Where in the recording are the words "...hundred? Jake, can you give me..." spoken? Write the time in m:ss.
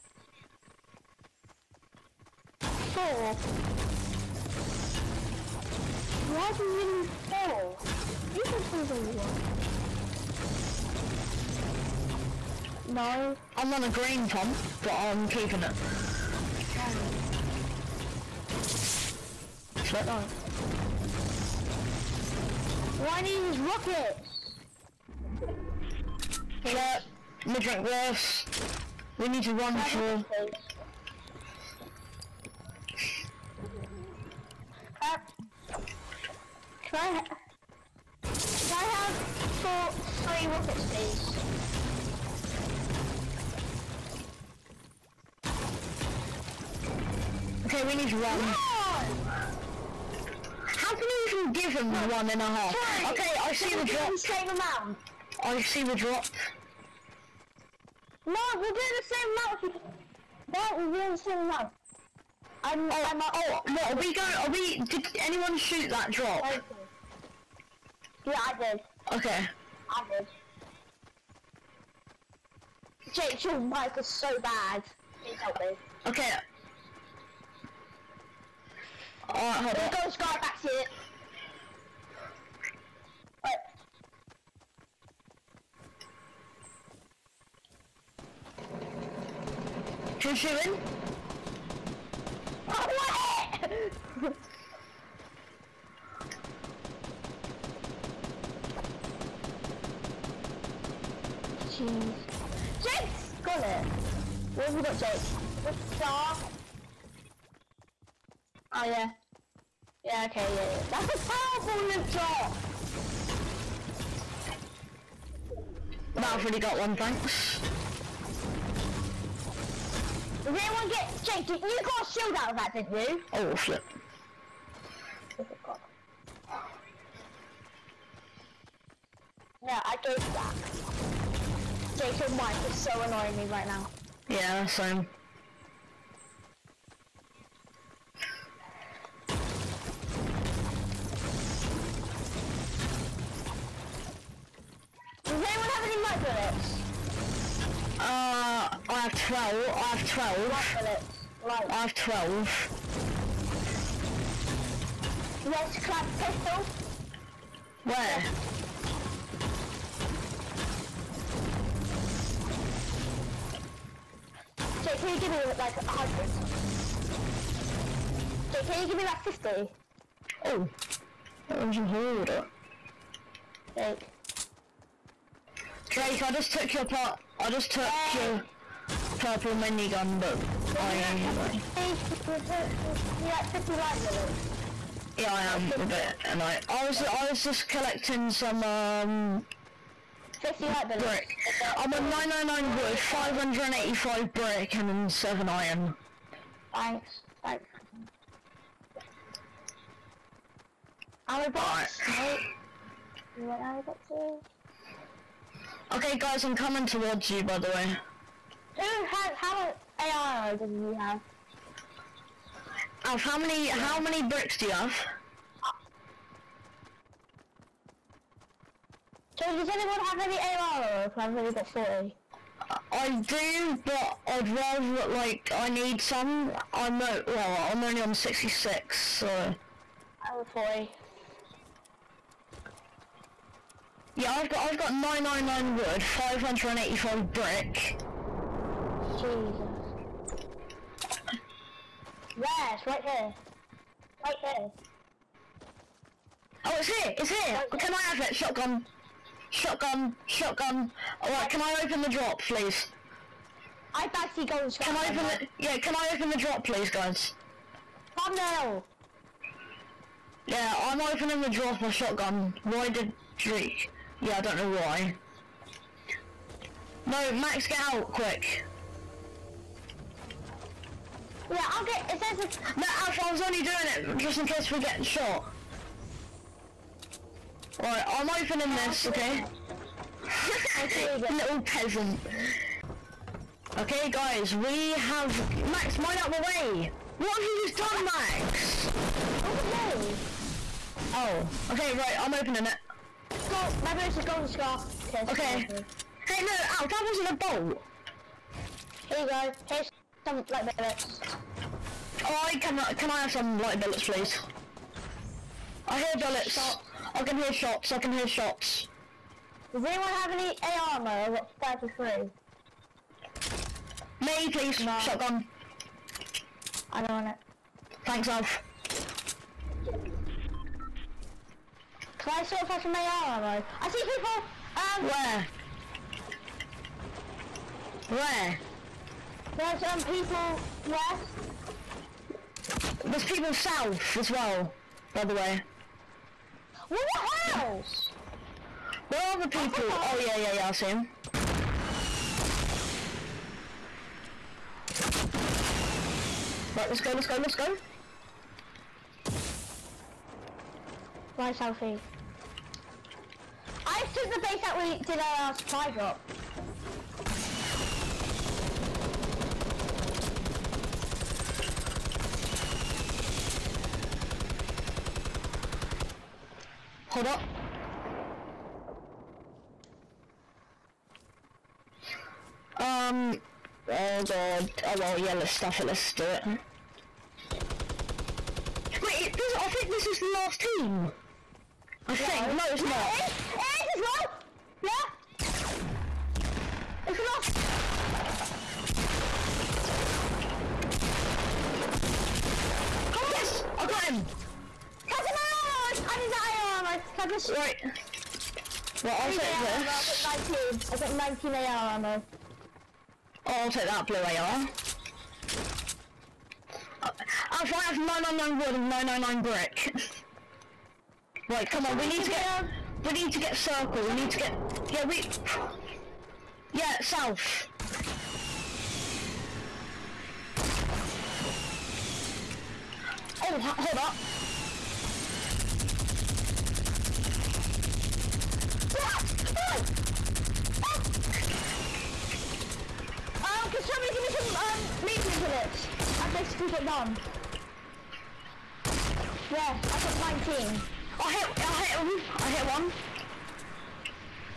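2:45.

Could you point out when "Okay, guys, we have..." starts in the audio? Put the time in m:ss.
4:43.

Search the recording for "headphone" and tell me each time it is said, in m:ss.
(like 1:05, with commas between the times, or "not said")
not said.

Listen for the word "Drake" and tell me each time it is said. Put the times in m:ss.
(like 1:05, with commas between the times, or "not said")
2:55, 4:23.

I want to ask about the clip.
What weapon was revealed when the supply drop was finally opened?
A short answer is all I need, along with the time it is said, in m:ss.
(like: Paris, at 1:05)
golden SCAR, at 4:54.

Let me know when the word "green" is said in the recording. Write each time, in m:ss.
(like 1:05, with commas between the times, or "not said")
0:13.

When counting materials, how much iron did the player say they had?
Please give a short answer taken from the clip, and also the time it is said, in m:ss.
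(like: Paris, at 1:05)
7, at 3:15.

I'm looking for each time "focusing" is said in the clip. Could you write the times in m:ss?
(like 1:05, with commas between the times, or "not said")
not said.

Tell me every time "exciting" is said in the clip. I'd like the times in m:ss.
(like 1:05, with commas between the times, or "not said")
not said.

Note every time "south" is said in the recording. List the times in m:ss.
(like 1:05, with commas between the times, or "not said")
5:33, 6:57.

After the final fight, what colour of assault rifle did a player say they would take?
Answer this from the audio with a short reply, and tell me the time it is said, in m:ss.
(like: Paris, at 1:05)
blue, at 6:44.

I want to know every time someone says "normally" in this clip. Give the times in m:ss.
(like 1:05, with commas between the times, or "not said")
not said.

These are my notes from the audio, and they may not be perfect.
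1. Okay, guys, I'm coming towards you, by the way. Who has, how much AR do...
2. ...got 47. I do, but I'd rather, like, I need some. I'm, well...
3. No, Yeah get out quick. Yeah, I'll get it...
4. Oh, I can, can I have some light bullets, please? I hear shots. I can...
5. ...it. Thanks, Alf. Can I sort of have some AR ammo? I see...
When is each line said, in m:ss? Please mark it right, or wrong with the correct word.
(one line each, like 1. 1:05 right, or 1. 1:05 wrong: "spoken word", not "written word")
1. 3:25 right
2. 3:41 wrong: "40", not "47"
3. 4:27 wrong: "Max", not "Yeah"
4. 5:02 wrong: "bullets", not "shots"
5. 5:17 right.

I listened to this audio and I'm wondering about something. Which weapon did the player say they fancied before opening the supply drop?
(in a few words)
golden shotgun.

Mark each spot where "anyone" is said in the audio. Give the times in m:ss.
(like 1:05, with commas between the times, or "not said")
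1:05, 2:00, 2:25, 3:39, 5:09.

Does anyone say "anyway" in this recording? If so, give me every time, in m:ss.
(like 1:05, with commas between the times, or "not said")
3:00.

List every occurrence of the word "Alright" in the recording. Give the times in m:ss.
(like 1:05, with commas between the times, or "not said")
1:19, 4:11.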